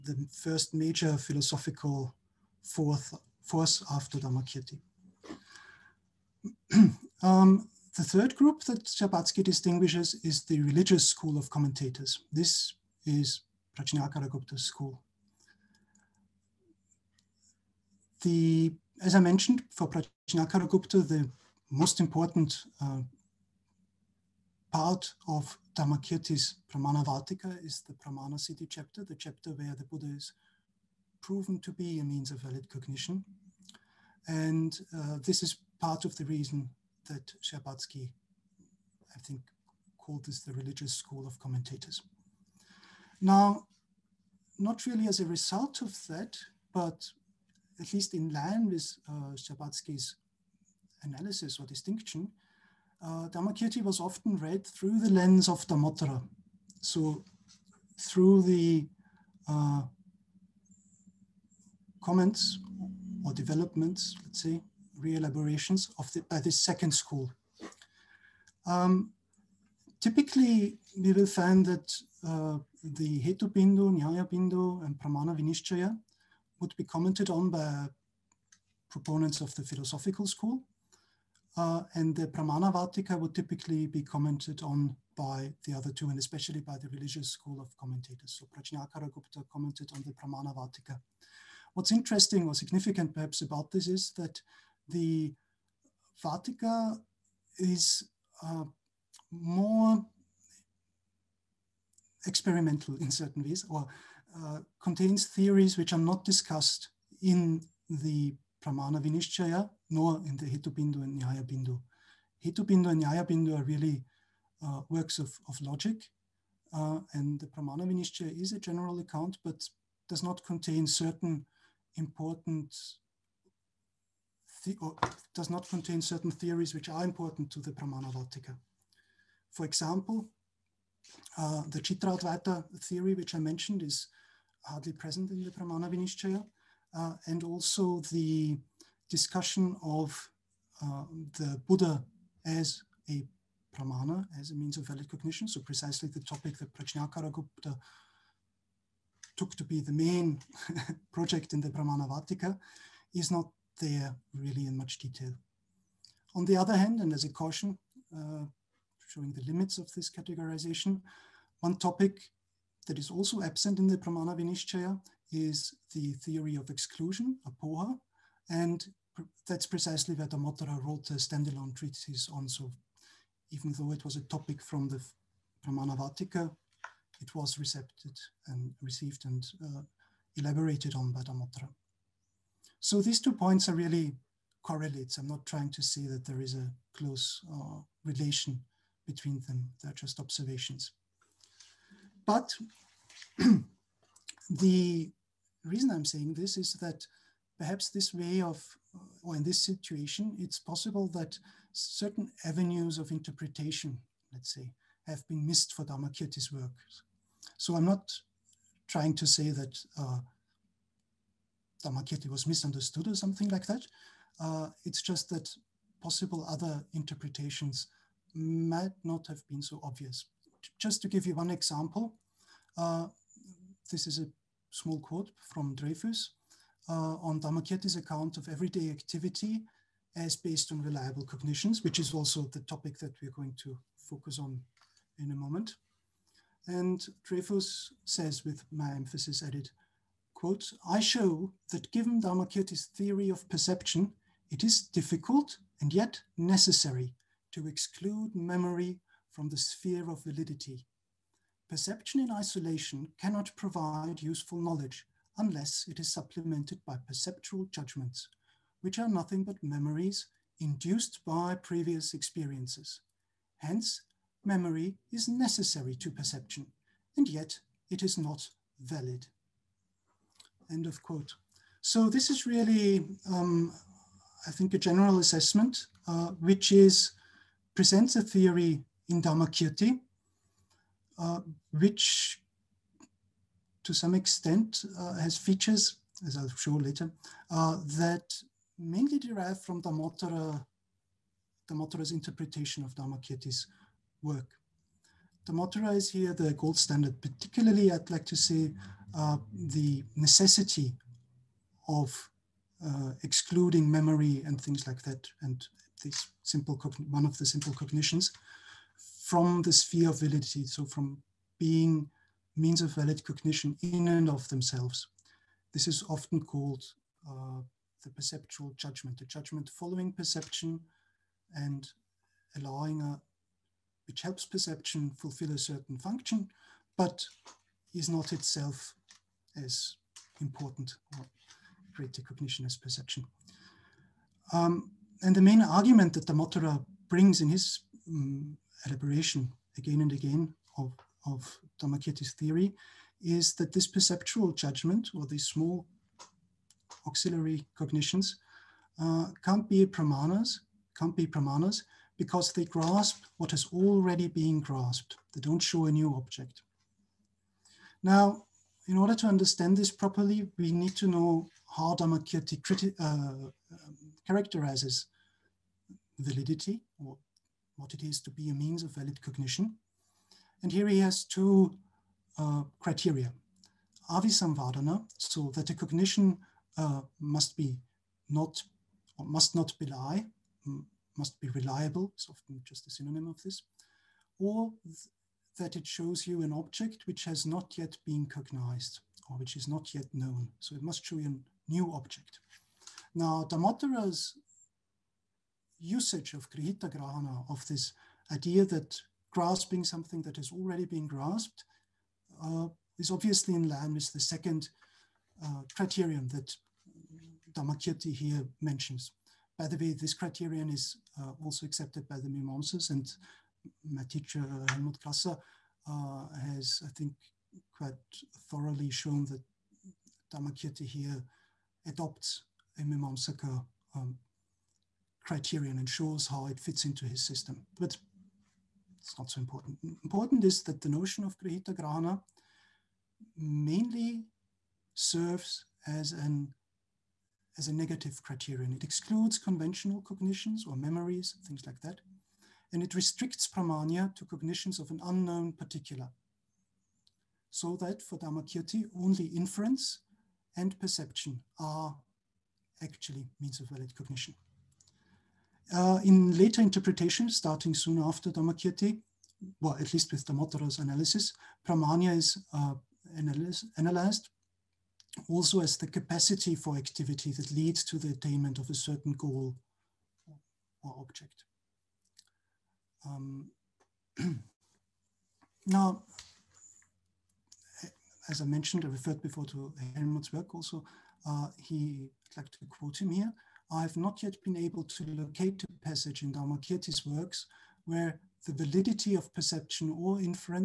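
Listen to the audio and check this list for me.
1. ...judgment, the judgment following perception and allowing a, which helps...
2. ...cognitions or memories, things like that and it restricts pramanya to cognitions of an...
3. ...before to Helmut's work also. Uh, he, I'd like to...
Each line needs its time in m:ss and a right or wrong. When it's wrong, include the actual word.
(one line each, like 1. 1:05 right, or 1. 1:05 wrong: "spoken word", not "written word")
1. 5:18 right
2. 7:20 right
3. 7:59 right.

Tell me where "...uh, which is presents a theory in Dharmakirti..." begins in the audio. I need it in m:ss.
4:36.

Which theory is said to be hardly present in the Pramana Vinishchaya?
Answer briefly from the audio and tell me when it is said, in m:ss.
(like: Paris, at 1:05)
Chitra theory, at 2:11.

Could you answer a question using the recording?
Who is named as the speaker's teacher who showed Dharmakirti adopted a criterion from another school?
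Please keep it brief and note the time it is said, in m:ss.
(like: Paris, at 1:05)
Helmut Krasser, at 6:54.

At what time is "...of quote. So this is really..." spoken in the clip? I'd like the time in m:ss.
4:30.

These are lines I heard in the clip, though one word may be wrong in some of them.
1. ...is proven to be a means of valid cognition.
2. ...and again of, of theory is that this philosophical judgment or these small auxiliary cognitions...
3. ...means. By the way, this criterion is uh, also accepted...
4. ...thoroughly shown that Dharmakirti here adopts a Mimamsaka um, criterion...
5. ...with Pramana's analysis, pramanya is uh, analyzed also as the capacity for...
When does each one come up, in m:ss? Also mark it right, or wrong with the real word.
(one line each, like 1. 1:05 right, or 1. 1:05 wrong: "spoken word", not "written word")
1. 0:30 right
2. 5:40 wrong: "perceptual", not "philosophical"
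3. 6:48 wrong: "mentions", not "means"
4. 6:58 right
5. 7:40 wrong: "Dharmottara", not "Pramana".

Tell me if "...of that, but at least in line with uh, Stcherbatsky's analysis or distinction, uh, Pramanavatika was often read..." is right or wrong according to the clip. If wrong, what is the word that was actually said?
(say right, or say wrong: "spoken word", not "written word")
wrong: "Dharmakirti", not "Pramanavatika".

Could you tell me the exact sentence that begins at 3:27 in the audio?
So I'm not trying to say that uh, Dharmakirti was misunderstood or something like that.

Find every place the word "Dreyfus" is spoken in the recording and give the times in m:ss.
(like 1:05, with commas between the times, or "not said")
3:45, 3:57.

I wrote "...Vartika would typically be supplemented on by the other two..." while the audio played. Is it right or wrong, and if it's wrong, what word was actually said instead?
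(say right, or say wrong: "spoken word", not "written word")
wrong: "commented", not "supplemented".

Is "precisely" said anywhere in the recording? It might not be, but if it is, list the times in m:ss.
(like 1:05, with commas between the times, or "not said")
2:25, 2:49.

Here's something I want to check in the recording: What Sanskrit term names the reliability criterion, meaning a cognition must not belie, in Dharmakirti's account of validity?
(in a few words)
Avisamvadana.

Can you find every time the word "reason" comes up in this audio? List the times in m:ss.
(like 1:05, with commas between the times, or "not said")
0:36, 3:15.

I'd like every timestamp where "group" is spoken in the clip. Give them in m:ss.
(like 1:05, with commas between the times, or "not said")
0:08.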